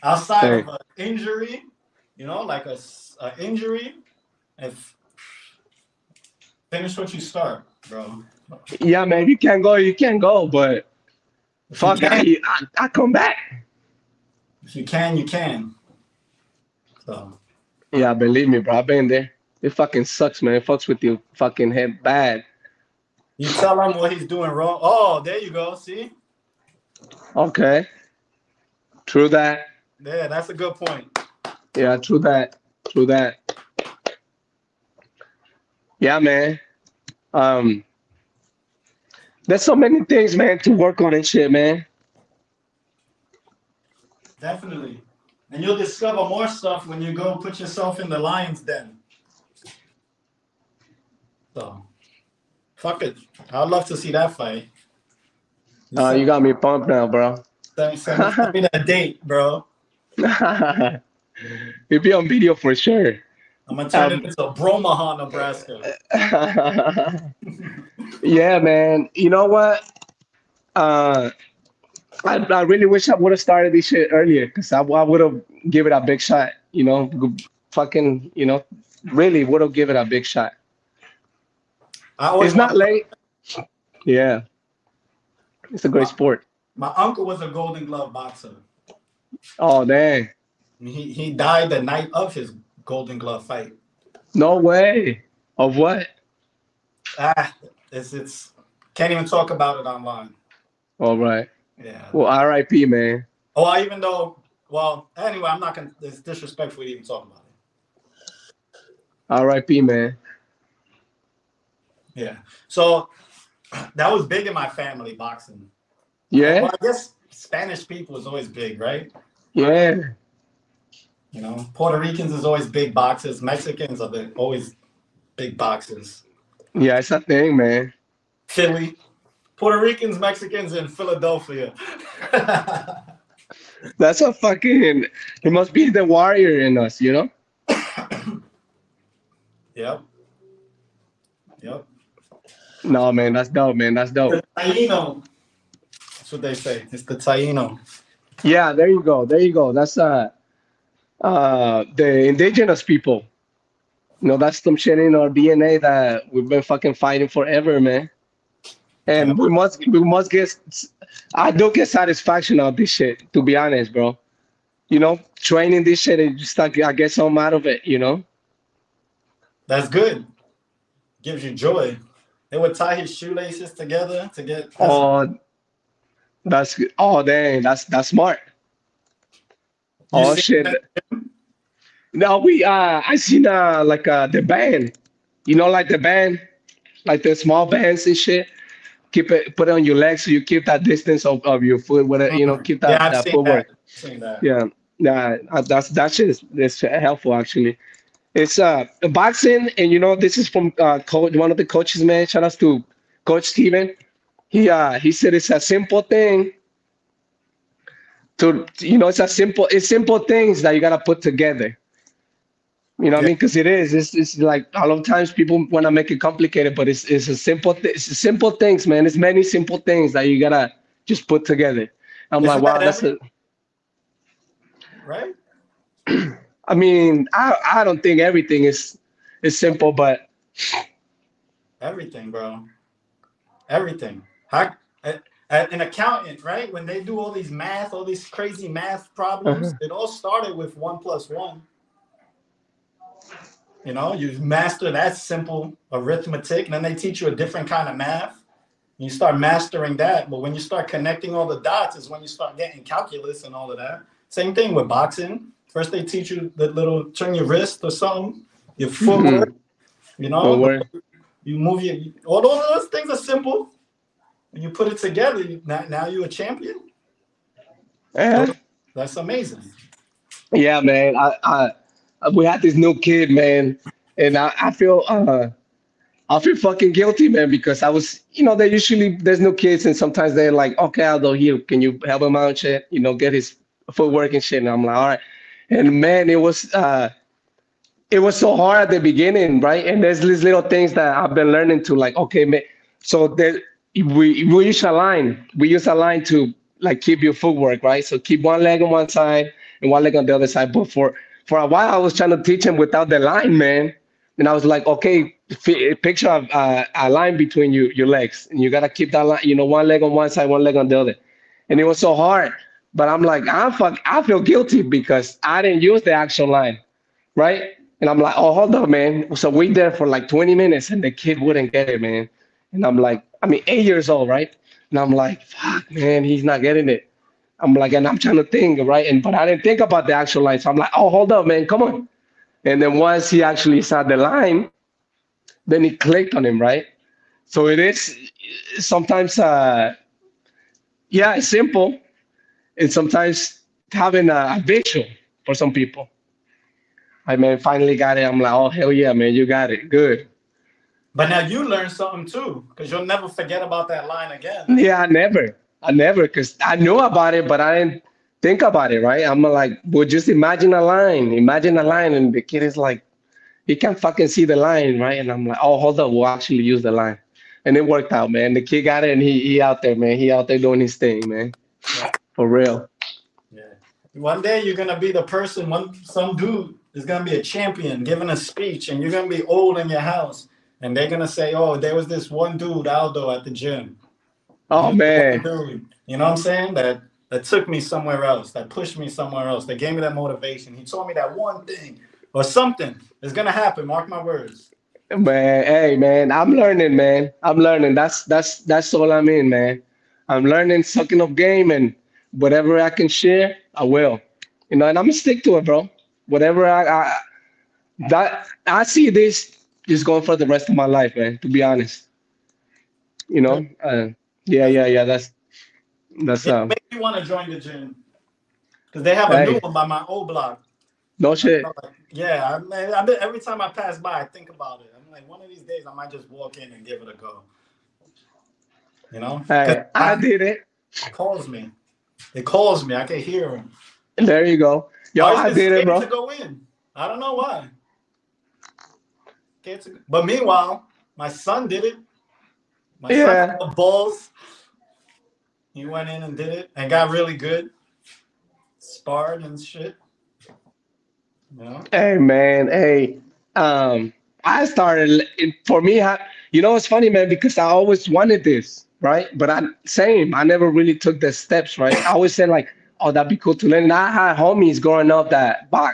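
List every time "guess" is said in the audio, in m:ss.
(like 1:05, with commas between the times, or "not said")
1:56.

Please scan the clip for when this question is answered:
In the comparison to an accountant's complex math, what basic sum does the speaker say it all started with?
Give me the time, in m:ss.
4:00.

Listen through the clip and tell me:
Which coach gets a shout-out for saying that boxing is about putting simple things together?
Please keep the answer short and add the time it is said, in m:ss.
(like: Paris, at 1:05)
Coach Steven, at 3:23.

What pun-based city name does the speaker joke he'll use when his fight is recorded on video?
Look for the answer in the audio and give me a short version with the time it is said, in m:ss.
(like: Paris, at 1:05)
Bromaha, Nebraska, at 1:04.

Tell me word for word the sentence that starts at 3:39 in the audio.
It's many simple things that you gotta just put together.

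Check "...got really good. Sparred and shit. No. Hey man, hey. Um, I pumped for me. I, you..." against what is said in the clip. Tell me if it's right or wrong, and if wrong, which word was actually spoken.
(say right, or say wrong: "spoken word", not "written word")
wrong: "started", not "pumped".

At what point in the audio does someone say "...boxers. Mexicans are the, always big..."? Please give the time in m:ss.
2:02.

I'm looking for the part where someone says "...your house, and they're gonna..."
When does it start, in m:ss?
6:19.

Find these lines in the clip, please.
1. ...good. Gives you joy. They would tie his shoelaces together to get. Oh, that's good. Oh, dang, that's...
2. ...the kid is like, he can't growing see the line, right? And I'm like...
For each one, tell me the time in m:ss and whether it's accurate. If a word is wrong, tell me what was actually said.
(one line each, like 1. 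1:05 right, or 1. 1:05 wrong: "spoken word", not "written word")
1. 2:49 right
2. 6:02 wrong: "fucking", not "growing".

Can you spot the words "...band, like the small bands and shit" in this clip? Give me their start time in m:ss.
3:05.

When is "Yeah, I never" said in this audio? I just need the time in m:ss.
5:54.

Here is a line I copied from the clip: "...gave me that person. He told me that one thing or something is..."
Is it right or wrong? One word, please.
wrong.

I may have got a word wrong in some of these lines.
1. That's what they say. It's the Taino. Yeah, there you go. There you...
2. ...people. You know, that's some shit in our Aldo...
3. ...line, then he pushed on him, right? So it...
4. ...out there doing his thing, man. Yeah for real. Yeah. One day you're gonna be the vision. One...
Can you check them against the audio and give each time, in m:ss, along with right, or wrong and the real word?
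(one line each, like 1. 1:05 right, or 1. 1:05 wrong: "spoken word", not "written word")
1. 2:26 right
2. 2:32 wrong: "DNA", not "Aldo"
3. 5:34 wrong: "clicked", not "pushed"
4. 6:10 wrong: "person", not "vision".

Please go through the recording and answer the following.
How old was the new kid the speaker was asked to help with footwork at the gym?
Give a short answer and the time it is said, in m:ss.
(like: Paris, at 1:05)
8, at 5:23.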